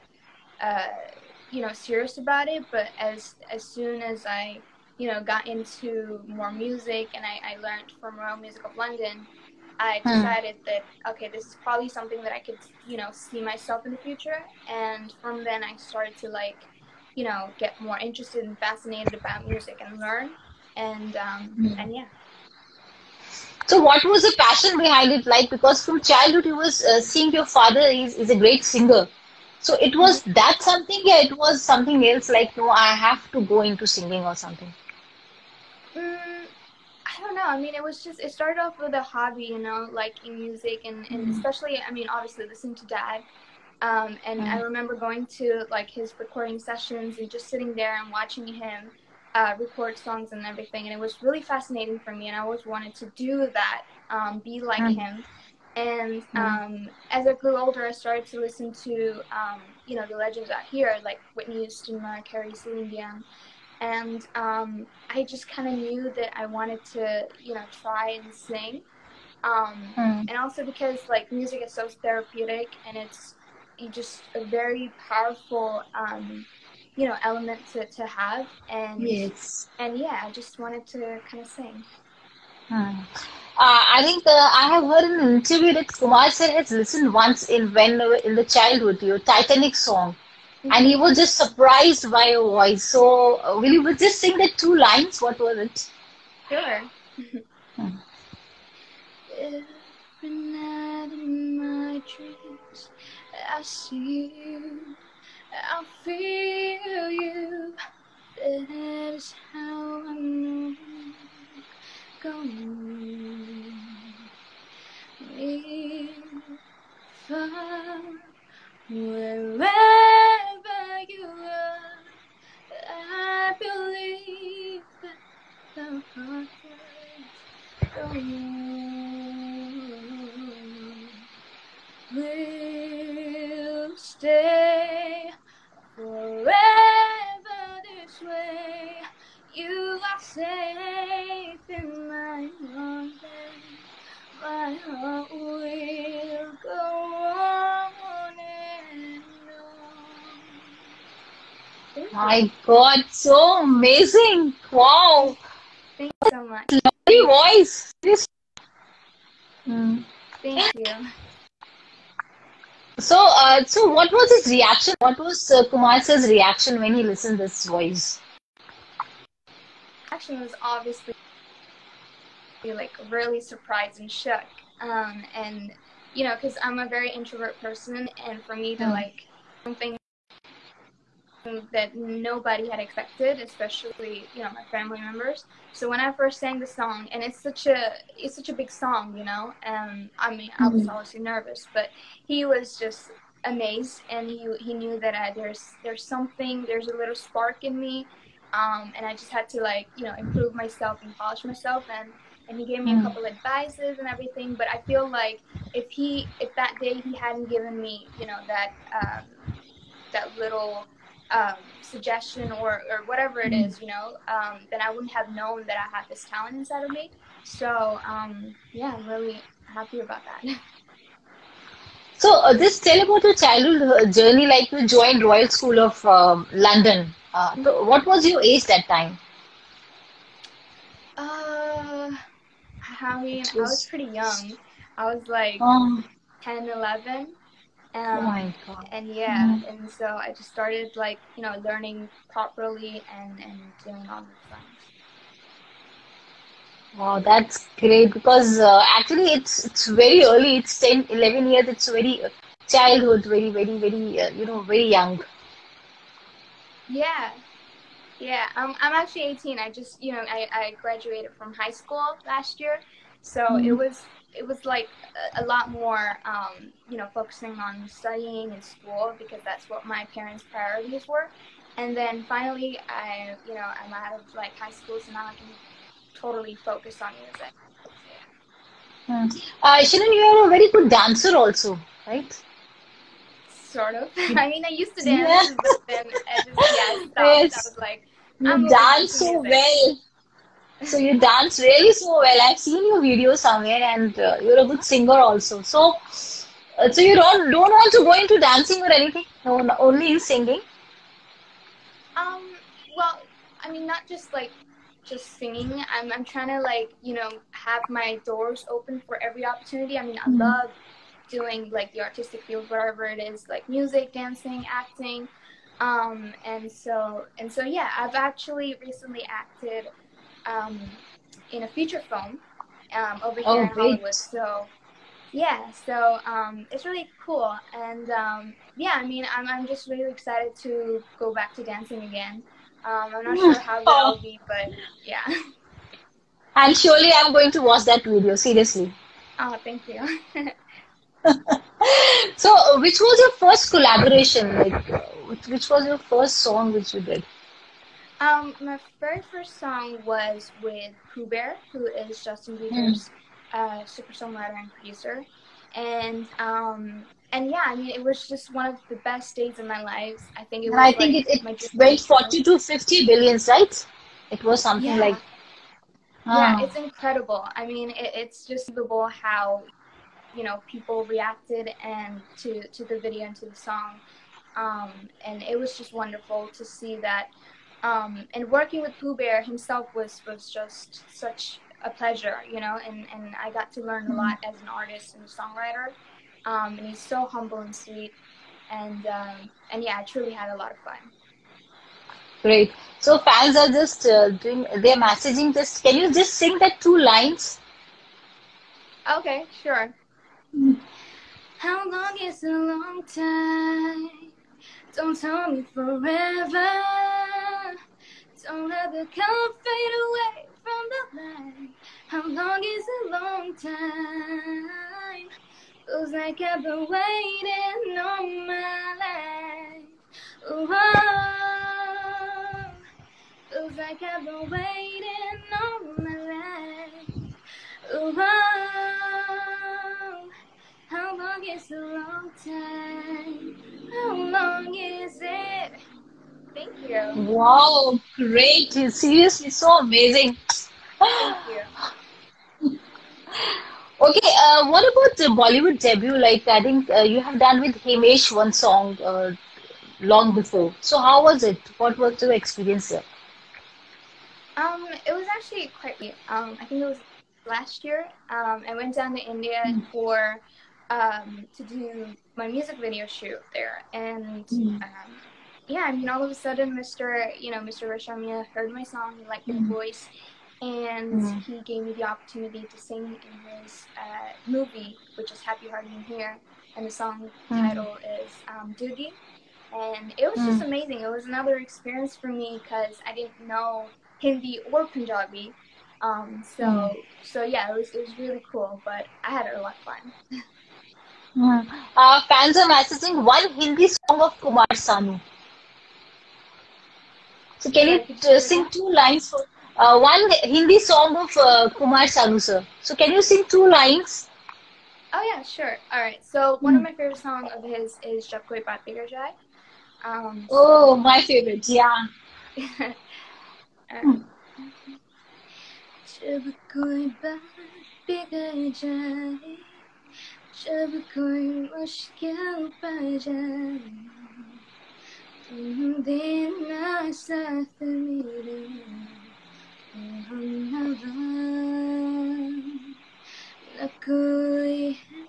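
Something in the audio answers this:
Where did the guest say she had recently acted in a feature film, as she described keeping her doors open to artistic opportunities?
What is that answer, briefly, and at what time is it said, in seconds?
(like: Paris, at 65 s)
Hollywood, at 323 s.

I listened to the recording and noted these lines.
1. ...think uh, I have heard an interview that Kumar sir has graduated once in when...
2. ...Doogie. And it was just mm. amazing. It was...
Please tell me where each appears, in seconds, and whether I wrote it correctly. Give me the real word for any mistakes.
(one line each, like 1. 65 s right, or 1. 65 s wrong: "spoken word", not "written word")
1. 84 s wrong: "listened", not "graduated"
2. 478 s right.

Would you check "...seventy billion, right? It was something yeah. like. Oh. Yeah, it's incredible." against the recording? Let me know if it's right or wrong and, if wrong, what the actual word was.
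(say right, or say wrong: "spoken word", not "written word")
wrong: "fifty", not "seventy".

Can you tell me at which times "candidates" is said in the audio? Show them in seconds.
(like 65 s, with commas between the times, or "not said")
not said.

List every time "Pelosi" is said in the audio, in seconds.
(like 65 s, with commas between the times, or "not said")
not said.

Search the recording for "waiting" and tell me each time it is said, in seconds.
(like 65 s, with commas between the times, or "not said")
416 s, 424 s.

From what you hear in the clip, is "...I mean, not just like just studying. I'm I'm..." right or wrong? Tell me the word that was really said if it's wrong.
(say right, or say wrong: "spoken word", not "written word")
wrong: "singing", not "studying".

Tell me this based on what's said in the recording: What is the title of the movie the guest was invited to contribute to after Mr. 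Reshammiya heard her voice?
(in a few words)
Happy Hardy and Heer.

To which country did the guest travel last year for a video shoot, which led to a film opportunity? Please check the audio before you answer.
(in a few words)
India.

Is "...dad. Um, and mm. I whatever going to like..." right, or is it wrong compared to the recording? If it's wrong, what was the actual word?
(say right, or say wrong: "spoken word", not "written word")
wrong: "remember", not "whatever".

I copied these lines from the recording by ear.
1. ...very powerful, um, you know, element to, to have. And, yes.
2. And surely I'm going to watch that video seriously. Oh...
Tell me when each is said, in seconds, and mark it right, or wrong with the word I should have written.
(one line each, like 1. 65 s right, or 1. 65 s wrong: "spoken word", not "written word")
1. 74 s right
2. 336 s right.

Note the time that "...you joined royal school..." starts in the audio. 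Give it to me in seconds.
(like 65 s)
224 s.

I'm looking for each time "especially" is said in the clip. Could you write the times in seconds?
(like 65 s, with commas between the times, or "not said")
41 s, 183 s.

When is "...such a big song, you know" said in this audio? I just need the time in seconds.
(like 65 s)
188 s.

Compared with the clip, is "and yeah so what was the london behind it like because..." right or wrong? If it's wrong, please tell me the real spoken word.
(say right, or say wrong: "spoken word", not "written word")
wrong: "passion", not "london".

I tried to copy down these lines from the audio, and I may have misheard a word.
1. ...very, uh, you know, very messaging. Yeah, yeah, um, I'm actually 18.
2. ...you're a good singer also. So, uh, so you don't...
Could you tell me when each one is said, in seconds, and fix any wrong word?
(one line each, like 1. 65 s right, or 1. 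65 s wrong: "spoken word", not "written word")
1. 253 s wrong: "young", not "messaging"
2. 294 s right.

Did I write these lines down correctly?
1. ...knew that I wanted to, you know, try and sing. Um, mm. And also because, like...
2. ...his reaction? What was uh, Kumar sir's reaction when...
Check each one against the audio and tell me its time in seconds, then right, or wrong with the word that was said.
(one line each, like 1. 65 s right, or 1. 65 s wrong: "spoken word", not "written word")
1. 65 s right
2. 164 s right.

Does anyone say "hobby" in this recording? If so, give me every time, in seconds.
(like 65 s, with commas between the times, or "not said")
39 s.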